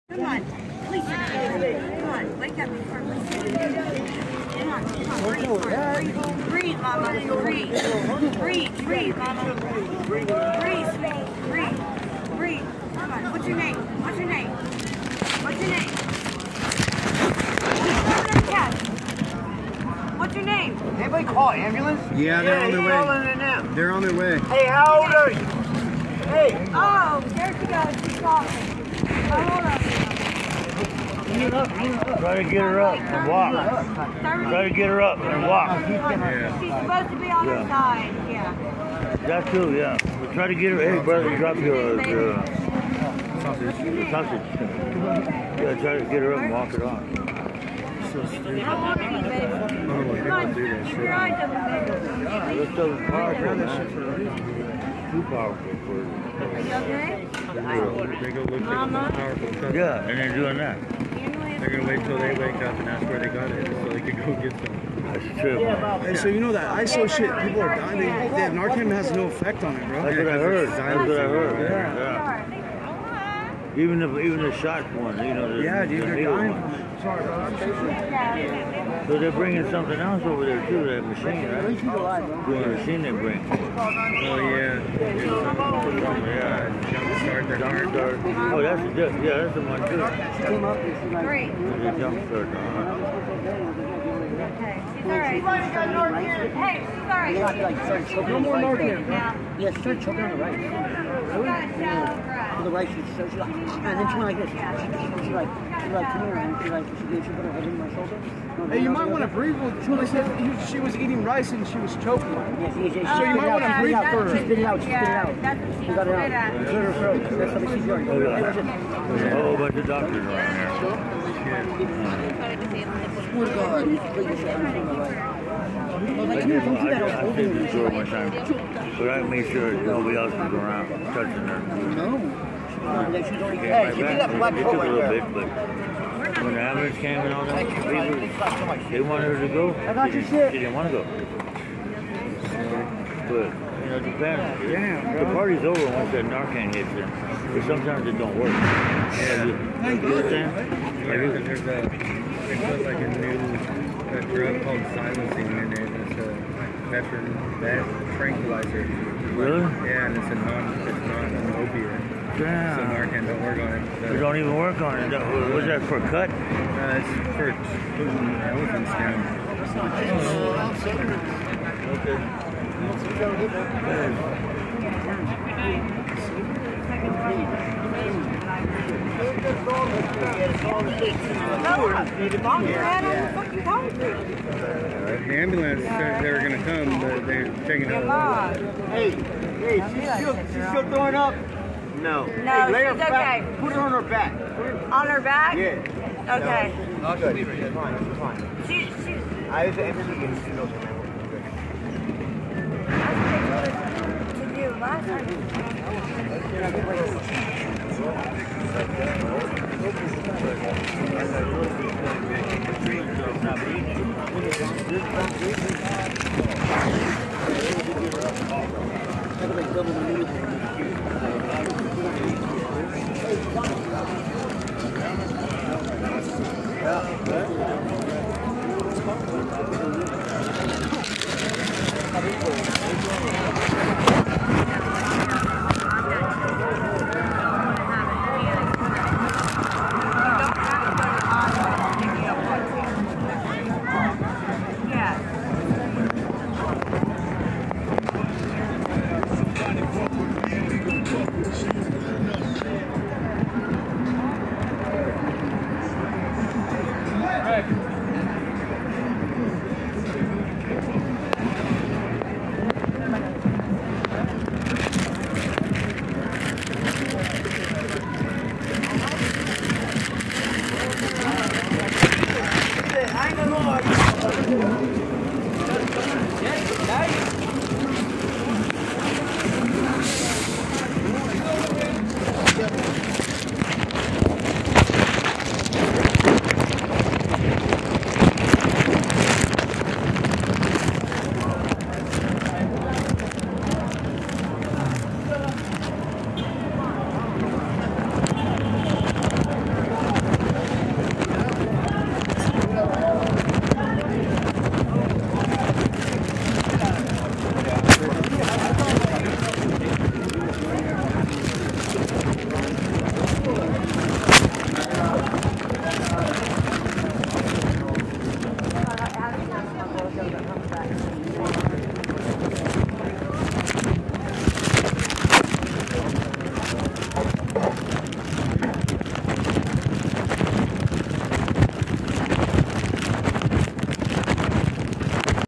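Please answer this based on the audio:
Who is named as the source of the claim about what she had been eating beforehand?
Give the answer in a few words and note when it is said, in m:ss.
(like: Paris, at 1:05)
Julie, at 1:49.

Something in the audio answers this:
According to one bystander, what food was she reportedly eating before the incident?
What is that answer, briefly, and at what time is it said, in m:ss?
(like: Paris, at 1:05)
rice, at 1:51.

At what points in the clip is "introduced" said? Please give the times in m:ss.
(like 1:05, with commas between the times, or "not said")
not said.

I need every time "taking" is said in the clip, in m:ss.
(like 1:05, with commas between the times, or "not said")
3:07.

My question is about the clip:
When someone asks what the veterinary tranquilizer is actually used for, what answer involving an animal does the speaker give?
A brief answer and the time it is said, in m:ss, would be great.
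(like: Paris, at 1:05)
elephant skin, at 2:48.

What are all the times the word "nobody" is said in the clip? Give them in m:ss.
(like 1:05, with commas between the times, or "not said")
2:09.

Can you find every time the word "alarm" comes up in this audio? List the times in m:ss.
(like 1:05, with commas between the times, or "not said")
not said.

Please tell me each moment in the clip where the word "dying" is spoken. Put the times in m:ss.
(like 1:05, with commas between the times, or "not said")
1:07, 1:16.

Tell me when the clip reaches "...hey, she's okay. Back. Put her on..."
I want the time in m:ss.
3:12.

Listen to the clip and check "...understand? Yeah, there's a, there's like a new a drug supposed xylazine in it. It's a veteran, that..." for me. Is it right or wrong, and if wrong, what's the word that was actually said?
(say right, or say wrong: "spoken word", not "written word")
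wrong: "called", not "supposed".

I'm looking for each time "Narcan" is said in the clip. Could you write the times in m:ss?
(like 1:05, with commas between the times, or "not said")
1:08, 2:26, 2:42.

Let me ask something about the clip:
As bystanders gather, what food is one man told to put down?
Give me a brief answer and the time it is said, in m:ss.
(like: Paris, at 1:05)
sausage, at 0:43.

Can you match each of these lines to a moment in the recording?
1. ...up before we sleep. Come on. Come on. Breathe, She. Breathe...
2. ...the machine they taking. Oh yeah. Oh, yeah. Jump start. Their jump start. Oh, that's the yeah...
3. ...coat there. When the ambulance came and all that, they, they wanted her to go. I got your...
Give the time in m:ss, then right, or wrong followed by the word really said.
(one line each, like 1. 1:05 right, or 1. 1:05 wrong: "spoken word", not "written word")
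1. 0:02 wrong: "Breathe", not "She"
2. 1:22 wrong: "bring", not "taking"
3. 2:14 right.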